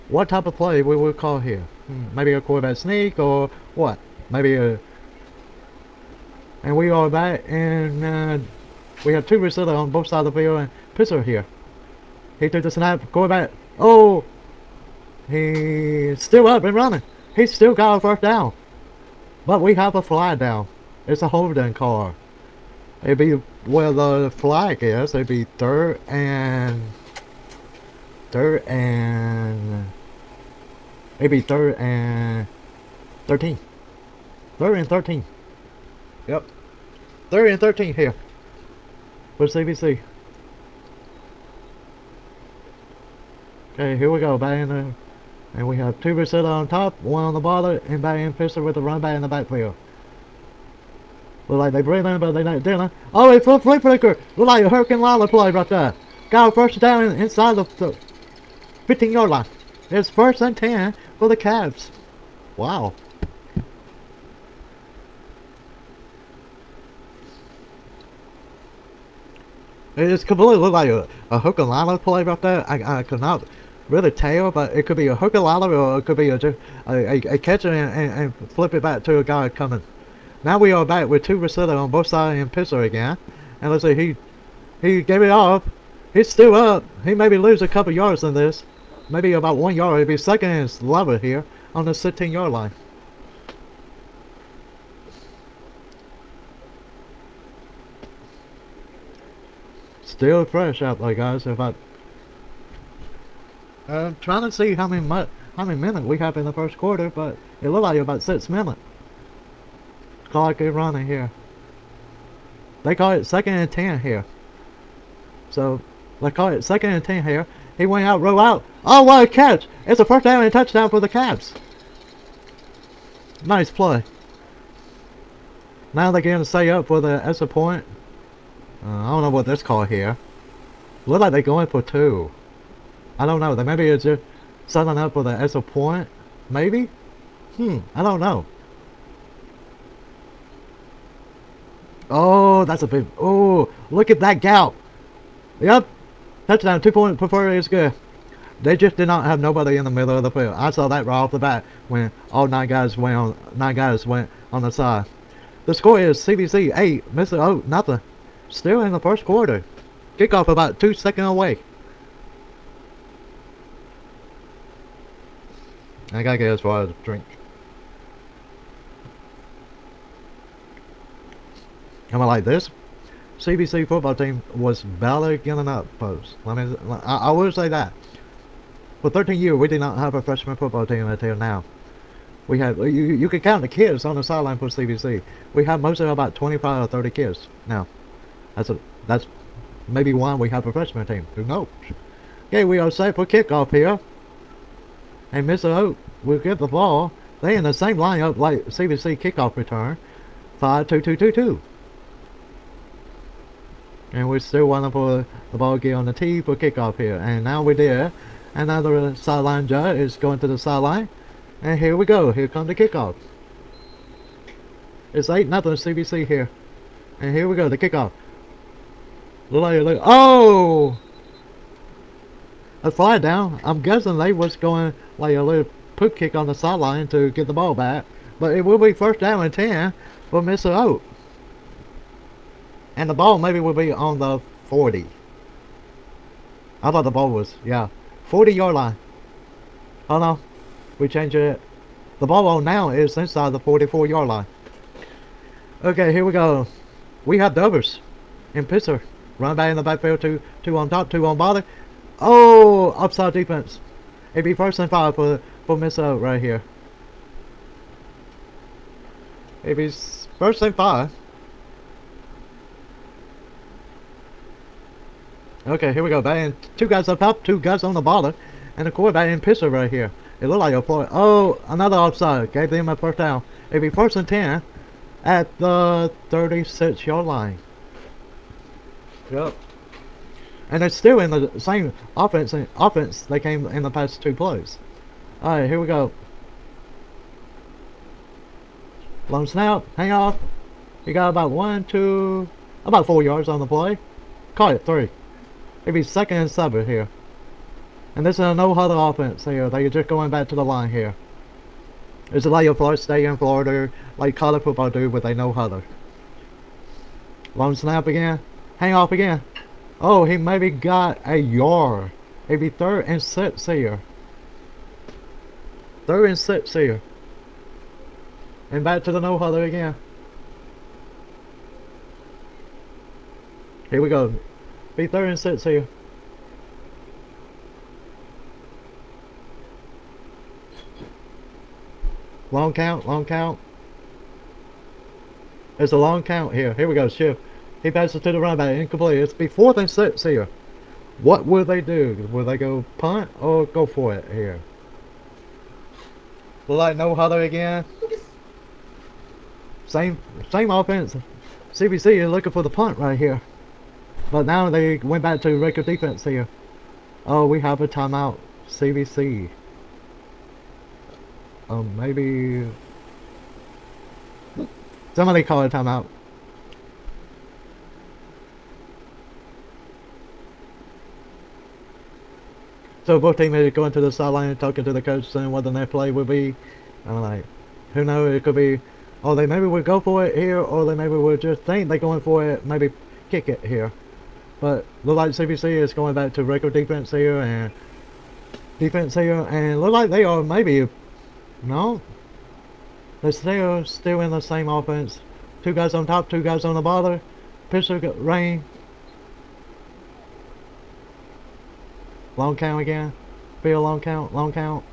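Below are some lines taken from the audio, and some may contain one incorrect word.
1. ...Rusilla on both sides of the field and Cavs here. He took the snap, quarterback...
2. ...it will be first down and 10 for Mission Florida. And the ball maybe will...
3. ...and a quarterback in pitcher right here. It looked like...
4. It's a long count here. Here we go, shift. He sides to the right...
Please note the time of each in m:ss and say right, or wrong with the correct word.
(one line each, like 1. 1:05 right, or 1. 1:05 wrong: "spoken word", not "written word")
1. 0:09 wrong: "Pisser", not "Cavs"
2. 3:48 wrong: "Oak", not "Florida"
3. 4:28 right
4. 5:35 wrong: "passes", not "sides".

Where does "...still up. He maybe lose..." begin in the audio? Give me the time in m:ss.
1:26.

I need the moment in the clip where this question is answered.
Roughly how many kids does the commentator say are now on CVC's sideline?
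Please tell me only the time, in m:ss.
3:06.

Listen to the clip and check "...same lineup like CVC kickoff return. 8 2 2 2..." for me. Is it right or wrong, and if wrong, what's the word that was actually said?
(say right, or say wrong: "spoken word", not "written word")
wrong: "5", not "8".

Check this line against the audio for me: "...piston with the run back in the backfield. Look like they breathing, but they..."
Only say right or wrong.
right.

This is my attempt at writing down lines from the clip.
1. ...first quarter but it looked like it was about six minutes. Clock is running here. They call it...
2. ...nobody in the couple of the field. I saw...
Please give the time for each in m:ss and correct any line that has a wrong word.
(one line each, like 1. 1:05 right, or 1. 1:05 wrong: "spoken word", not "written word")
1. 1:46 right
2. 2:29 wrong: "middle", not "couple".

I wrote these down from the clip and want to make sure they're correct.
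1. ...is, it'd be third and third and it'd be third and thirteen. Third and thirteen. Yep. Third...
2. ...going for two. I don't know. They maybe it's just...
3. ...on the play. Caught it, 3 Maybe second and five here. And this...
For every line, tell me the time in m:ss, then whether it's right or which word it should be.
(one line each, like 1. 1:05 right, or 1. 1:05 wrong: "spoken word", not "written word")
1. 0:24 right
2. 2:11 right
3. 4:53 wrong: "seven", not "five".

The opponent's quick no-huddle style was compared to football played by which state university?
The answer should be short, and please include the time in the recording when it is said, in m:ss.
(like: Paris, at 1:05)
Florida State, at 5:02.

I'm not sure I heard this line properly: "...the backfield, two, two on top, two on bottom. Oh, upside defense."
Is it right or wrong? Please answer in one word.
right.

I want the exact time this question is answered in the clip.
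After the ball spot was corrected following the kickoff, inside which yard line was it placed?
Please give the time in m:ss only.
4:03.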